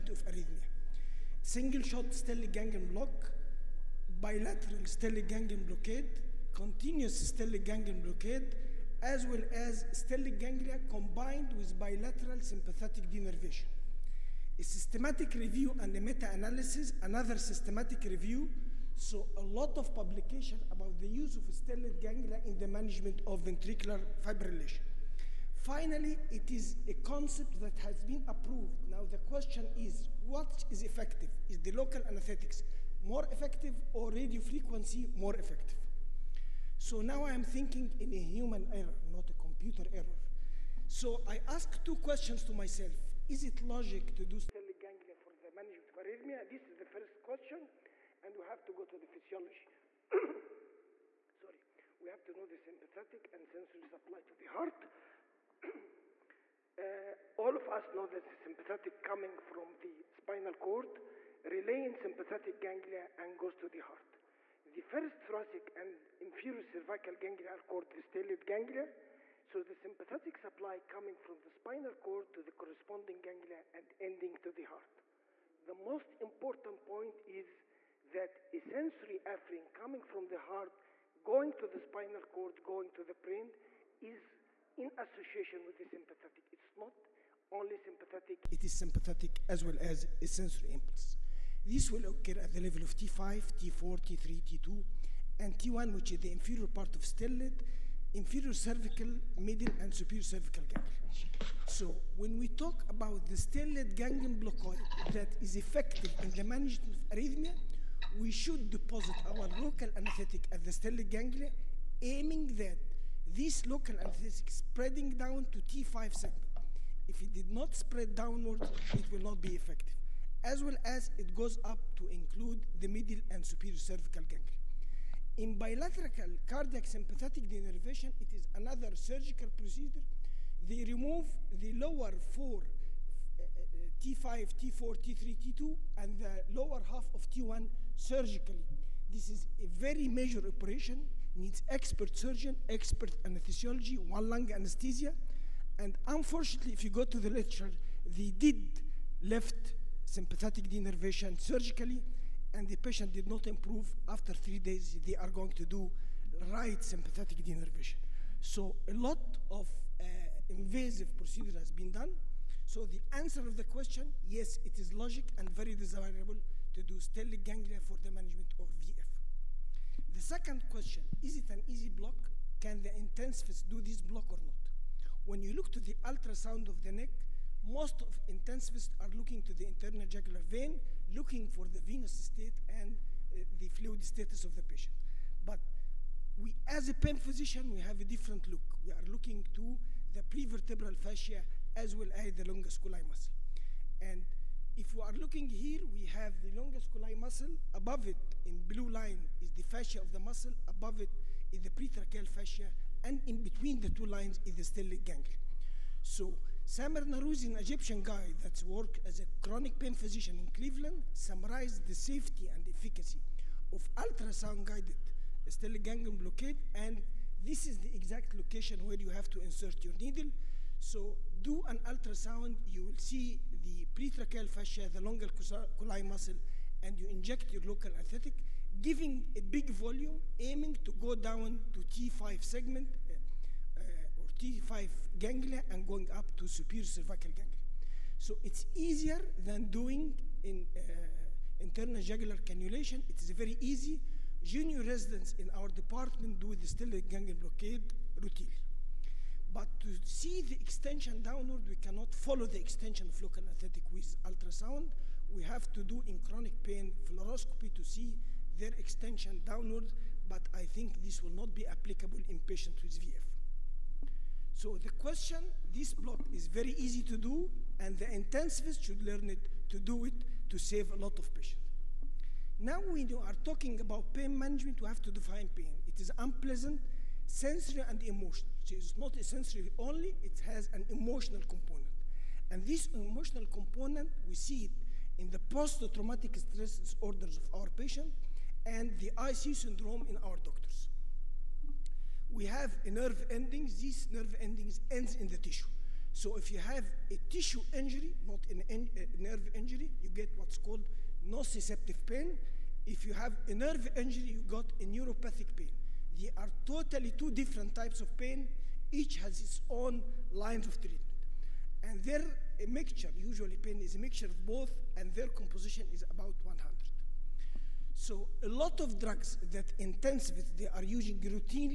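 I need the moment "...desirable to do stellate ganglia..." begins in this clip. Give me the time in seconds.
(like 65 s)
165 s.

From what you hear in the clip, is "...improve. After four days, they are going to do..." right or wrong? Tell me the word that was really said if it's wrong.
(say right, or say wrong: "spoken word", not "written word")
wrong: "three", not "four".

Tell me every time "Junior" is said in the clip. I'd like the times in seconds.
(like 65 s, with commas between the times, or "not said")
244 s.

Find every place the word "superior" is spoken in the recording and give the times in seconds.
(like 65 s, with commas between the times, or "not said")
99 s, 123 s, 236 s.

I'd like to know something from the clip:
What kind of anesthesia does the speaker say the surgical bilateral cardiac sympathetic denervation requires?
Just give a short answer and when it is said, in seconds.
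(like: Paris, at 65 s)
One lung anesthesia, at 144 s.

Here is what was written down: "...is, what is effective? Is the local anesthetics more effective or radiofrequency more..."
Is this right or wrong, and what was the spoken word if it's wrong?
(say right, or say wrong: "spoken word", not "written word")
right.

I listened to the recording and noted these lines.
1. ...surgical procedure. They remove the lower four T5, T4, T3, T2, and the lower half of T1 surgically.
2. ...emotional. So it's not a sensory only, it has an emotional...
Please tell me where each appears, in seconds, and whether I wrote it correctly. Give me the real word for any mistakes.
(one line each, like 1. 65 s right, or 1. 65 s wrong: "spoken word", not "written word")
1. 128 s right
2. 278 s right.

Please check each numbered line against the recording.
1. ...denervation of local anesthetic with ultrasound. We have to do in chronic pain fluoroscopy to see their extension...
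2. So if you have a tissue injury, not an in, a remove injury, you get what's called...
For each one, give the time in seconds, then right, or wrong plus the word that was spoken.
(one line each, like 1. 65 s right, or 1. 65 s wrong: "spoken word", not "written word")
1. 252 s wrong: "extension", not "denervation"
2. 296 s wrong: "nerve", not "remove".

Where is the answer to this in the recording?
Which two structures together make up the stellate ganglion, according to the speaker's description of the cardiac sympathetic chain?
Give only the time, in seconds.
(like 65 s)
64 s.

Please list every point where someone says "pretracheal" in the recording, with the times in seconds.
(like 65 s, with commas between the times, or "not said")
201 s, 223 s.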